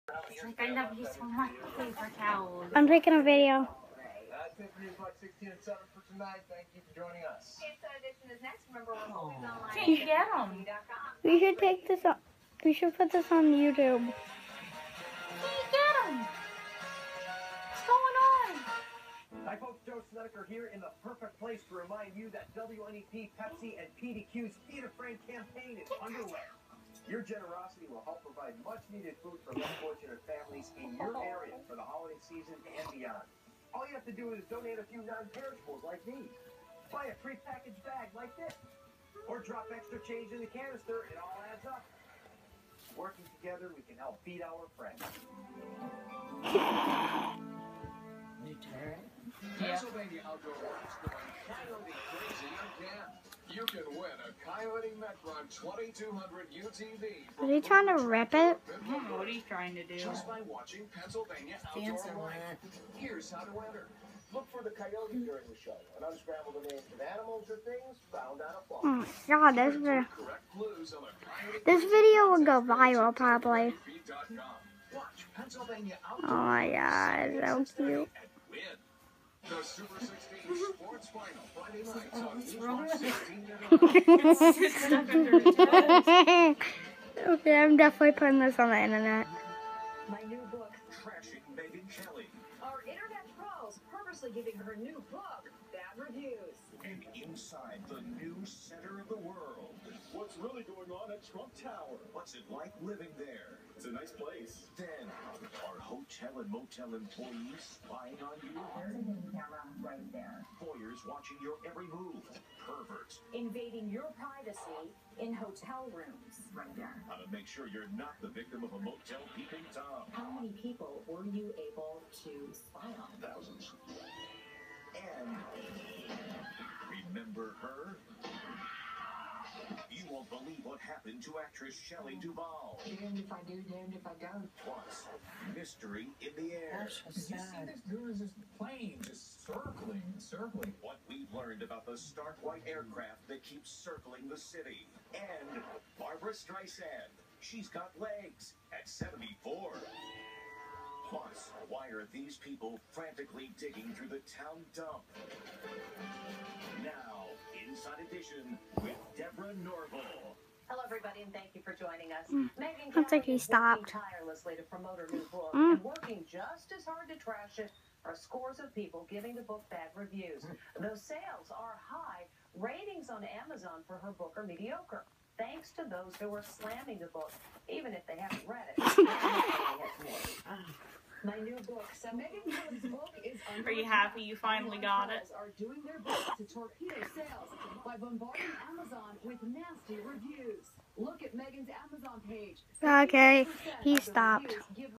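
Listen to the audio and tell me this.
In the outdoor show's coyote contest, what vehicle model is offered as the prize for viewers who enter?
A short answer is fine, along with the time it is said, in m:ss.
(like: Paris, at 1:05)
Kioti Mechron 2200 UTV, at 0:54.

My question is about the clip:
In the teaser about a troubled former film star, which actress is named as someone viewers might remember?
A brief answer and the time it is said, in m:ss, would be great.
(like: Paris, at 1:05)
Shelley Duvall, at 2:11.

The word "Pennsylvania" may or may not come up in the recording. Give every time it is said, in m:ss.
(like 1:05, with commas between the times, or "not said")
0:49, 1:00.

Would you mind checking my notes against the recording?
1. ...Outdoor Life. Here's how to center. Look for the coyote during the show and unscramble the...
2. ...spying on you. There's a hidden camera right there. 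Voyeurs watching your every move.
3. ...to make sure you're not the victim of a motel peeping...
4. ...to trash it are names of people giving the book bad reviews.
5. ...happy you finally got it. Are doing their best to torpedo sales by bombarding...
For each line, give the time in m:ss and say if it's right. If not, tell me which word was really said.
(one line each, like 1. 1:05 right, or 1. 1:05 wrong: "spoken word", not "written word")
1. 1:01 wrong: "enter", not "center"
2. 1:47 right
3. 1:57 right
4. 2:47 wrong: "scores", not "names"
5. 3:03 right.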